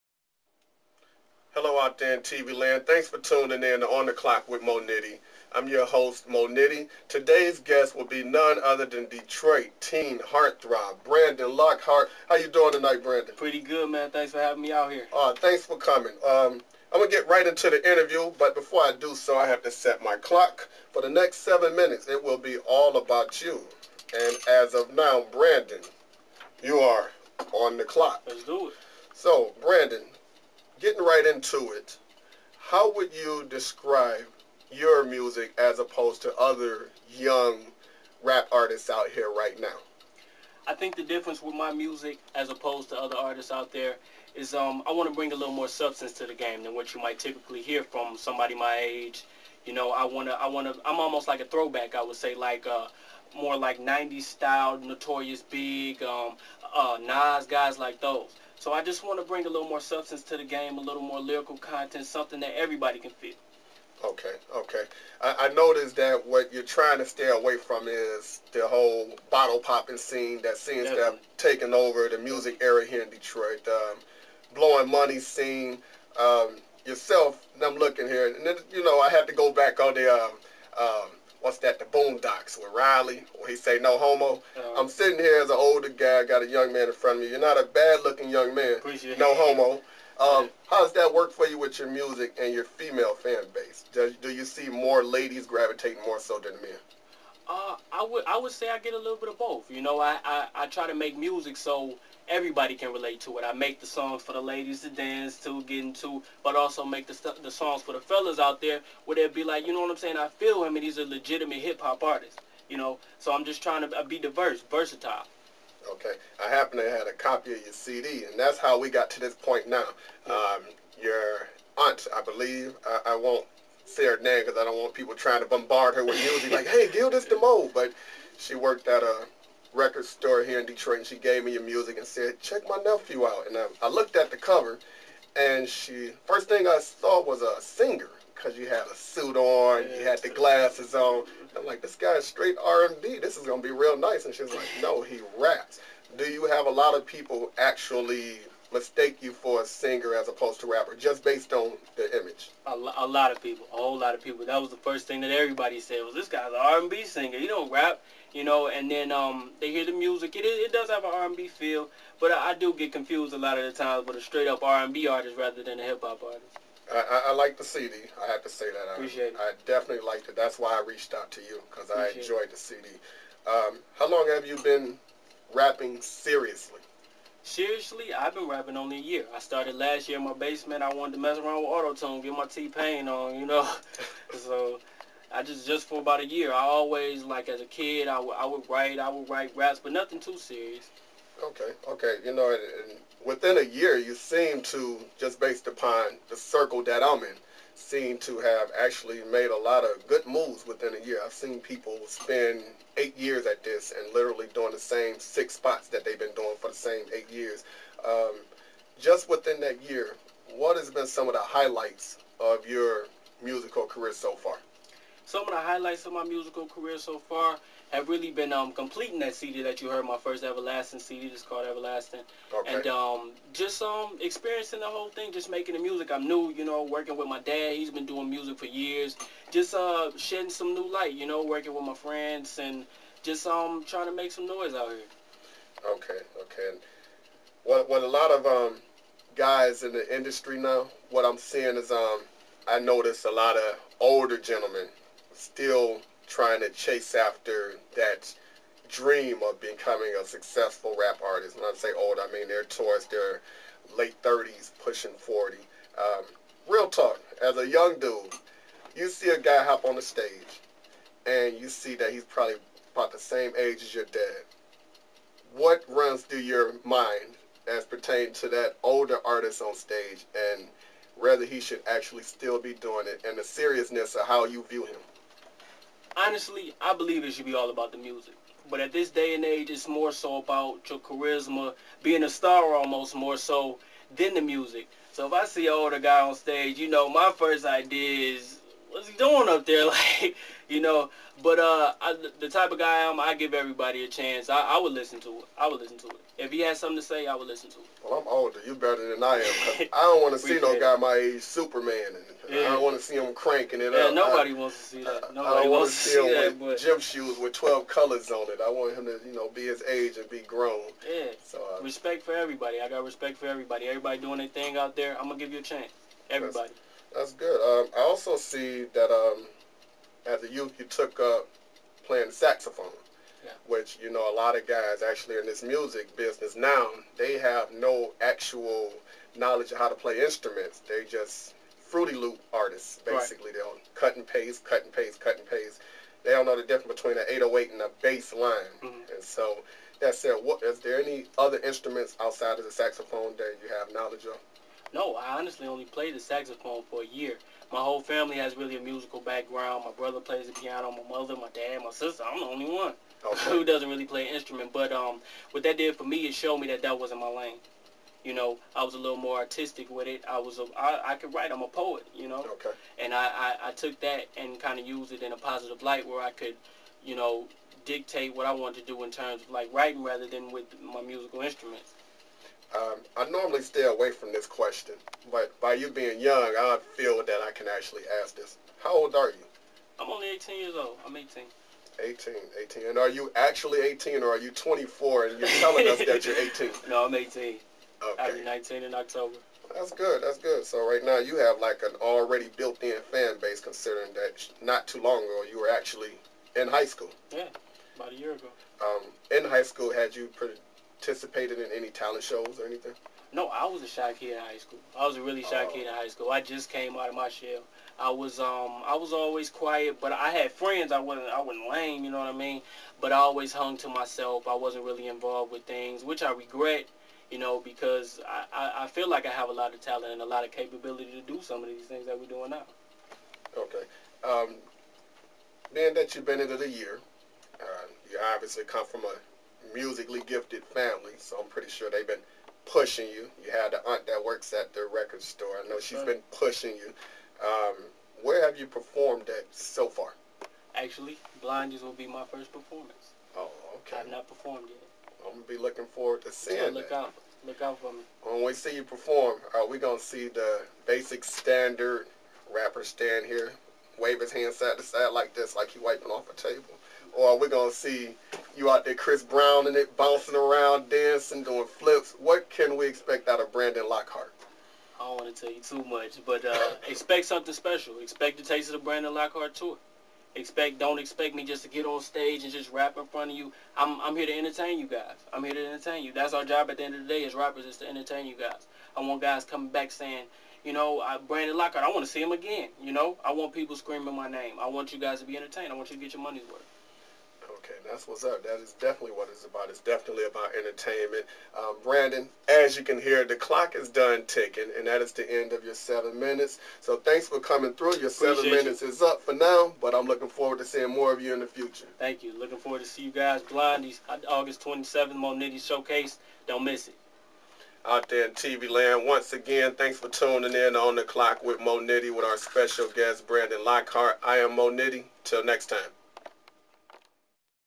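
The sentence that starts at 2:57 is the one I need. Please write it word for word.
Seriously, I've been rapping only a year.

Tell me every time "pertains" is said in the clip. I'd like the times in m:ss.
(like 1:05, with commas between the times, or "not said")
4:27.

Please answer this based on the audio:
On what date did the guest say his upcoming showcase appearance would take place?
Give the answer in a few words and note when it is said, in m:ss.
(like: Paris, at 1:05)
August 27, at 8:24.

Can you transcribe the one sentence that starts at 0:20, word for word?
For the next seven minutes, it will be all about you.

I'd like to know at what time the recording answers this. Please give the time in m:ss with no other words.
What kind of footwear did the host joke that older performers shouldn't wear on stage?
5:06.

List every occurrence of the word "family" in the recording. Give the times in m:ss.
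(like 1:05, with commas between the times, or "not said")
5:48, 7:10.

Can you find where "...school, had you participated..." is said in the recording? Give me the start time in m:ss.
6:39.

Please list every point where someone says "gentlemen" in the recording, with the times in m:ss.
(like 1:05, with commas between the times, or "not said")
4:04.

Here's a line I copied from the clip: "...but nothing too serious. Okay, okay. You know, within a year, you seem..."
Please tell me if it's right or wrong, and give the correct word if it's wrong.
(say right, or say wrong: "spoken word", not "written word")
right.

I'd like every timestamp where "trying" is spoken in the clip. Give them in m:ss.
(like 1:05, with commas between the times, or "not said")
1:06, 1:53, 2:05, 3:53, 4:06.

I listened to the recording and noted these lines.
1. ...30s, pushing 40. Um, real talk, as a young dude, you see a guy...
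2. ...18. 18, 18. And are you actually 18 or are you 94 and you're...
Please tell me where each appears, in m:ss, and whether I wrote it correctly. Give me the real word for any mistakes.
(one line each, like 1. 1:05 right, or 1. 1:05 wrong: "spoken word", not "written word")
1. 4:14 right
2. 6:21 wrong: "24", not "94".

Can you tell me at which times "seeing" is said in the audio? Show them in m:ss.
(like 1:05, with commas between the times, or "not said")
4:01, 7:26, 8:20.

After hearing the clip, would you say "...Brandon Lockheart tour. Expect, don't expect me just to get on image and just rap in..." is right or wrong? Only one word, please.
wrong.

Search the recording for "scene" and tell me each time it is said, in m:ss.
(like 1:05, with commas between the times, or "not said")
1:09, 1:15.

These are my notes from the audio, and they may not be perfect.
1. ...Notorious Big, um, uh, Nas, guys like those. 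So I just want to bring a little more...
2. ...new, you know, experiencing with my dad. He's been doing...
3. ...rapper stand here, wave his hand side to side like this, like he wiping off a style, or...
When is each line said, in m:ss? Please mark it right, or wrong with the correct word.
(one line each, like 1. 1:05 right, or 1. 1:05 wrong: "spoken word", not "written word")
1. 0:54 right
2. 3:46 wrong: "working", not "experiencing"
3. 7:32 wrong: "table", not "style".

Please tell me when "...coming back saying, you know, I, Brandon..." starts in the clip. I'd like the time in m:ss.
7:59.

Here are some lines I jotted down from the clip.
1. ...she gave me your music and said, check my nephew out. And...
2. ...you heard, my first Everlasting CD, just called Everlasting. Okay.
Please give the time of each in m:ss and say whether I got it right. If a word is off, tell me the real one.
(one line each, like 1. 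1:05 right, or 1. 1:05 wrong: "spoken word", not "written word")
1. 2:11 right
2. 3:39 right.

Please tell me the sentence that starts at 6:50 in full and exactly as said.
I wasn't I wasn't lame, you know what I mean.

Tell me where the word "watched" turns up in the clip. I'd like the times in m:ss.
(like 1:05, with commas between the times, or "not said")
not said.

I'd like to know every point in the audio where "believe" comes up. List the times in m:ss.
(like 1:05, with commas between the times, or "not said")
2:02, 4:36.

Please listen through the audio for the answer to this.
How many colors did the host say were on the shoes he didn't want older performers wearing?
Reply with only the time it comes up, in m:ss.
5:07.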